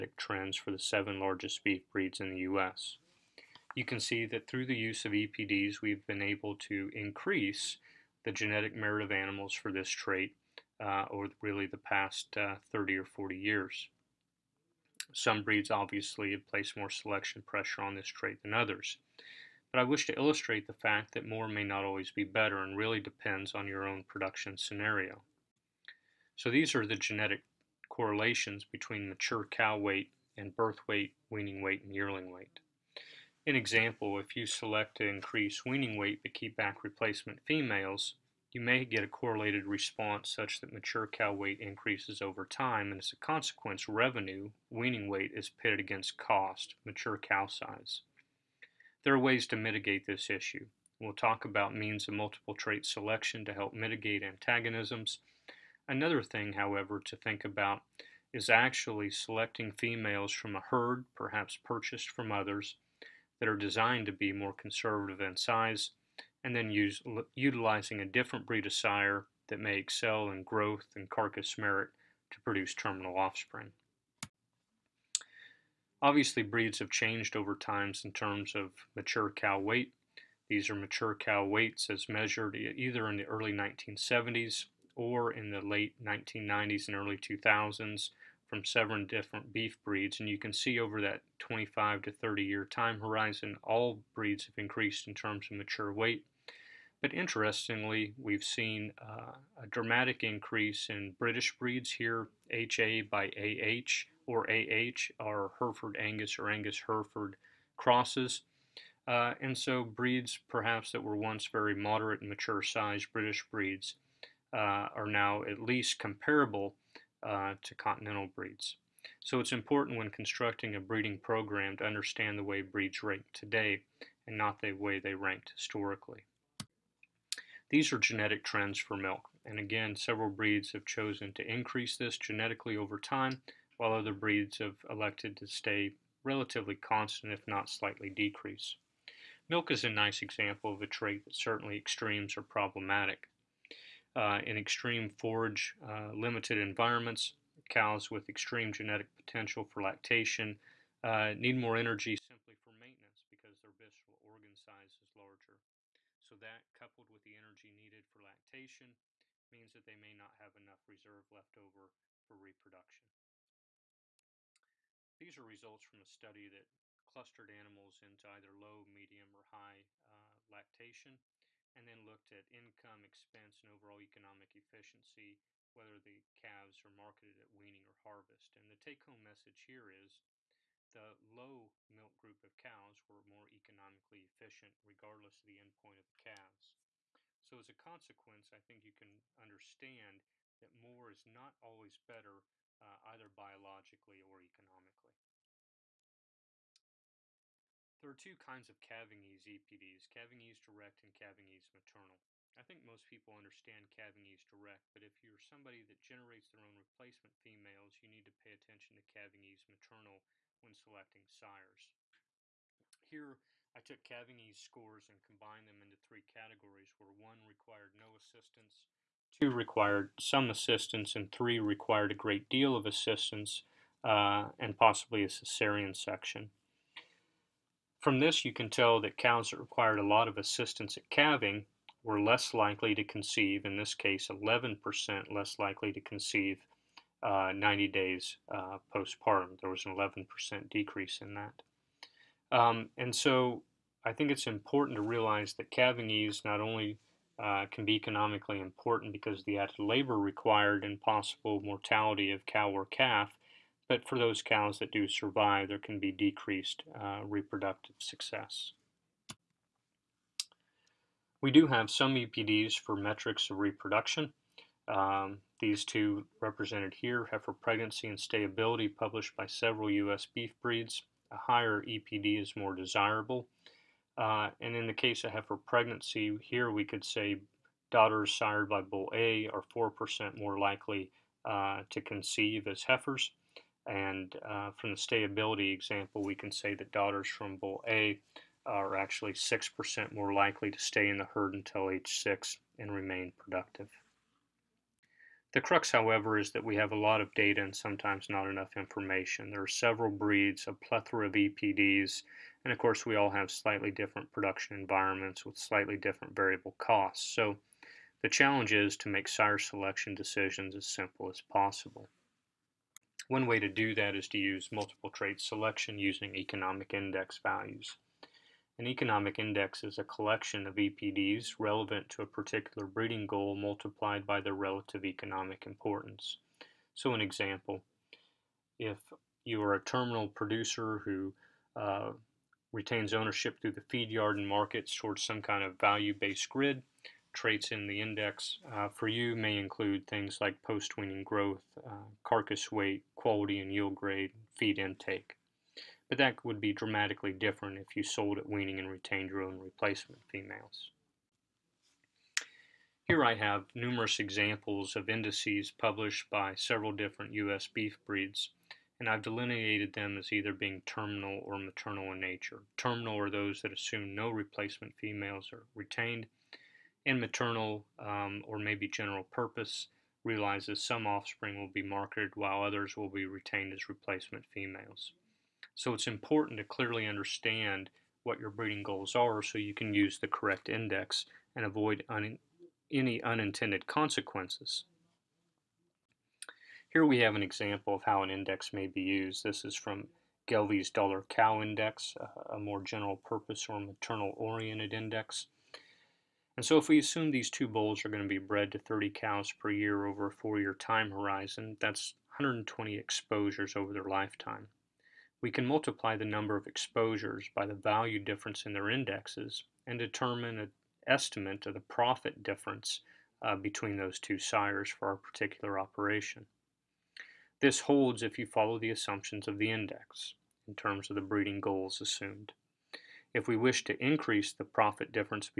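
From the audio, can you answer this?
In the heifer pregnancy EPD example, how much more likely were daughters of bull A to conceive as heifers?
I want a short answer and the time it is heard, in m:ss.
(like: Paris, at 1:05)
4%, at 4:39.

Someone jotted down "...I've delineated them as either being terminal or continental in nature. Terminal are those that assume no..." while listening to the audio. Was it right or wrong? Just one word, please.
wrong.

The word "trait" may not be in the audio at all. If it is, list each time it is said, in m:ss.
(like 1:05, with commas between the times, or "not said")
0:09, 0:18, 0:52, 2:20, 5:15, 5:37.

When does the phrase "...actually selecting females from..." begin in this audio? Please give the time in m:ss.
0:58.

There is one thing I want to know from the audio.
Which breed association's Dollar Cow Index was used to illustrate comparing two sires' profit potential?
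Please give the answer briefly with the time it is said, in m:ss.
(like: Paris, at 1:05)
Gelbvieh, at 6:30.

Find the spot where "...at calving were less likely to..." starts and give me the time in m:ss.
3:50.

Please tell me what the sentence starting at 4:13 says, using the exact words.
But for those cows that do survive, there can be decreased uh, reproductive success.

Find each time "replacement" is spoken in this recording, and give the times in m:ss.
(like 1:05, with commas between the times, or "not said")
0:36, 3:26, 5:49, 6:04, 6:13.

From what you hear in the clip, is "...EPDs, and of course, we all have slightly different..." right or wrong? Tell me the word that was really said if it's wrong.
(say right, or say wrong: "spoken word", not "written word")
right.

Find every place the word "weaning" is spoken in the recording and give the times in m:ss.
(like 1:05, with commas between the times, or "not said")
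0:31, 0:35, 0:44, 2:57, 5:40, 5:48.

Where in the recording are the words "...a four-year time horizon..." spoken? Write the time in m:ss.
6:40.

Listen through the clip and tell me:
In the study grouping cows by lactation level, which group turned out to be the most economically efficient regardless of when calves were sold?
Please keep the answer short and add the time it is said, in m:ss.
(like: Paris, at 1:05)
Low milk group, at 3:01.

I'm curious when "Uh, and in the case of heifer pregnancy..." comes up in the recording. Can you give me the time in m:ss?
4:34.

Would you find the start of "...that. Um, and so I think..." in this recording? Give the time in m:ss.
4:01.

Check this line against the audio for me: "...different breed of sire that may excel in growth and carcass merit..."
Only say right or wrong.
right.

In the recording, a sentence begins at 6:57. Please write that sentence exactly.
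This holds if you follow the assumptions of the index in terms of the breeding goals assumed.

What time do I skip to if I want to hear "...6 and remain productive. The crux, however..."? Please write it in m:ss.
4:52.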